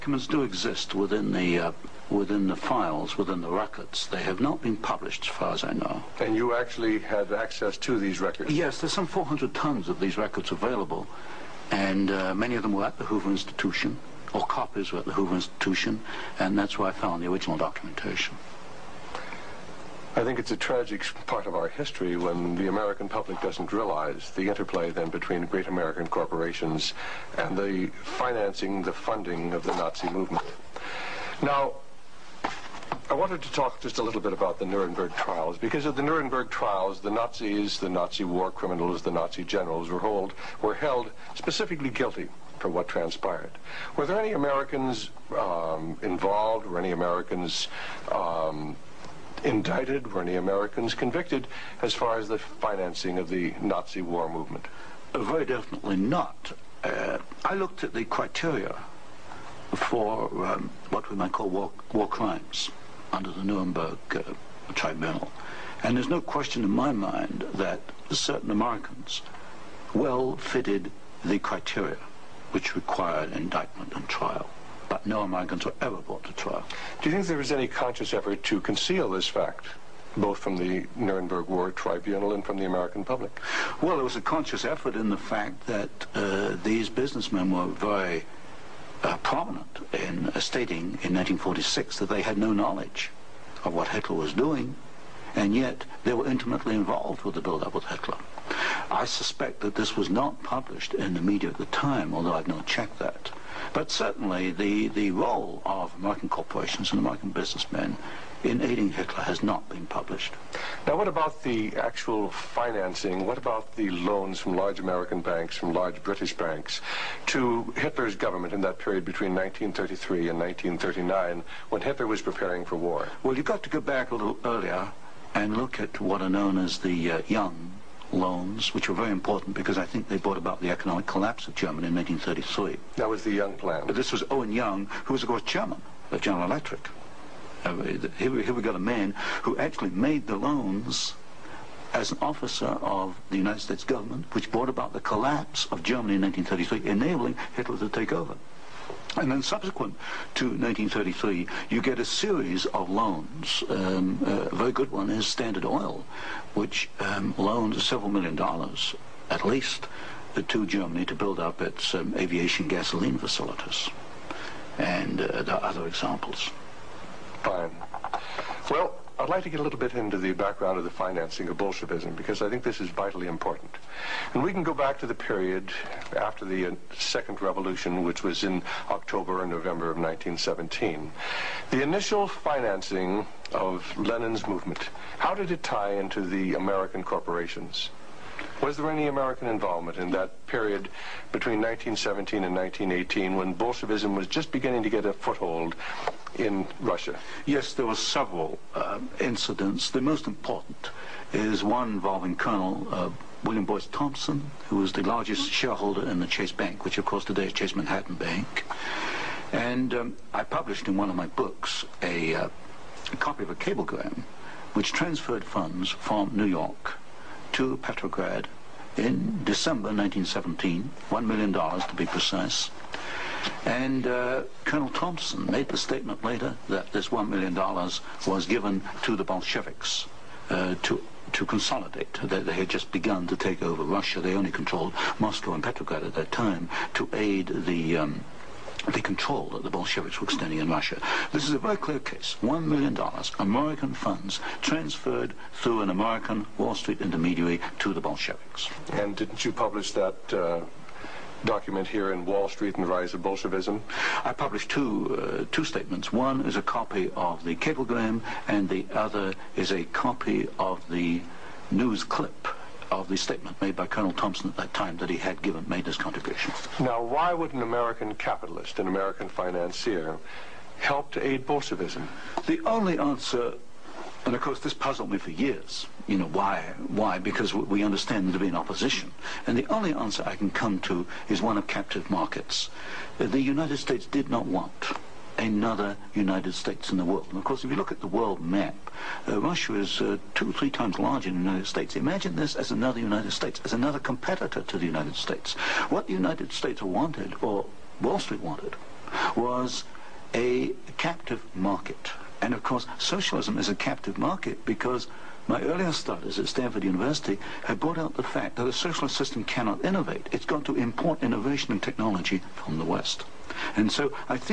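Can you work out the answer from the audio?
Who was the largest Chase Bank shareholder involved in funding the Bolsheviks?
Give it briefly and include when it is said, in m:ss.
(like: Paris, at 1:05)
William Boyce Thompson, at 3:23.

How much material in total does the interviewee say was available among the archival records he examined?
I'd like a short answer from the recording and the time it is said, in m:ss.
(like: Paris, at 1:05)
400 tons, at 0:09.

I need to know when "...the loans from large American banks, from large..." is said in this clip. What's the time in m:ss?
1:53.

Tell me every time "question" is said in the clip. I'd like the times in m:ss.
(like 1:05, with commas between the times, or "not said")
1:06.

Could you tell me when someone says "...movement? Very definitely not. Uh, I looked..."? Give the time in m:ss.
0:54.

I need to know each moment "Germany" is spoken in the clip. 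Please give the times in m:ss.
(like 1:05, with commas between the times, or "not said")
2:11, 2:25, 2:40.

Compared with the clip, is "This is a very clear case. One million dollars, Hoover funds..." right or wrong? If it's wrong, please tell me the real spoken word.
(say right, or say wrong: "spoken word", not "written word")
wrong: "American", not "Hoover".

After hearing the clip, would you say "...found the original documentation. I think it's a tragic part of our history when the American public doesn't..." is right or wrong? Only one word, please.
right.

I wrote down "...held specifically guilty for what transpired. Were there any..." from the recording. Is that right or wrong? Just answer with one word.
right.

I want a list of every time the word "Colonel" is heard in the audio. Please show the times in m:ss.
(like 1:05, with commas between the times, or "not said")
3:22, 3:44, 4:23.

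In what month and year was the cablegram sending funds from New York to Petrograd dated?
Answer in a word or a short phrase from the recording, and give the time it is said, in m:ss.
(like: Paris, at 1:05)
December 1917, at 3:39.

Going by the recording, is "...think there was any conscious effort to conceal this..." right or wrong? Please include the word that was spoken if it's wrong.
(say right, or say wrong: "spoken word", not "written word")
right.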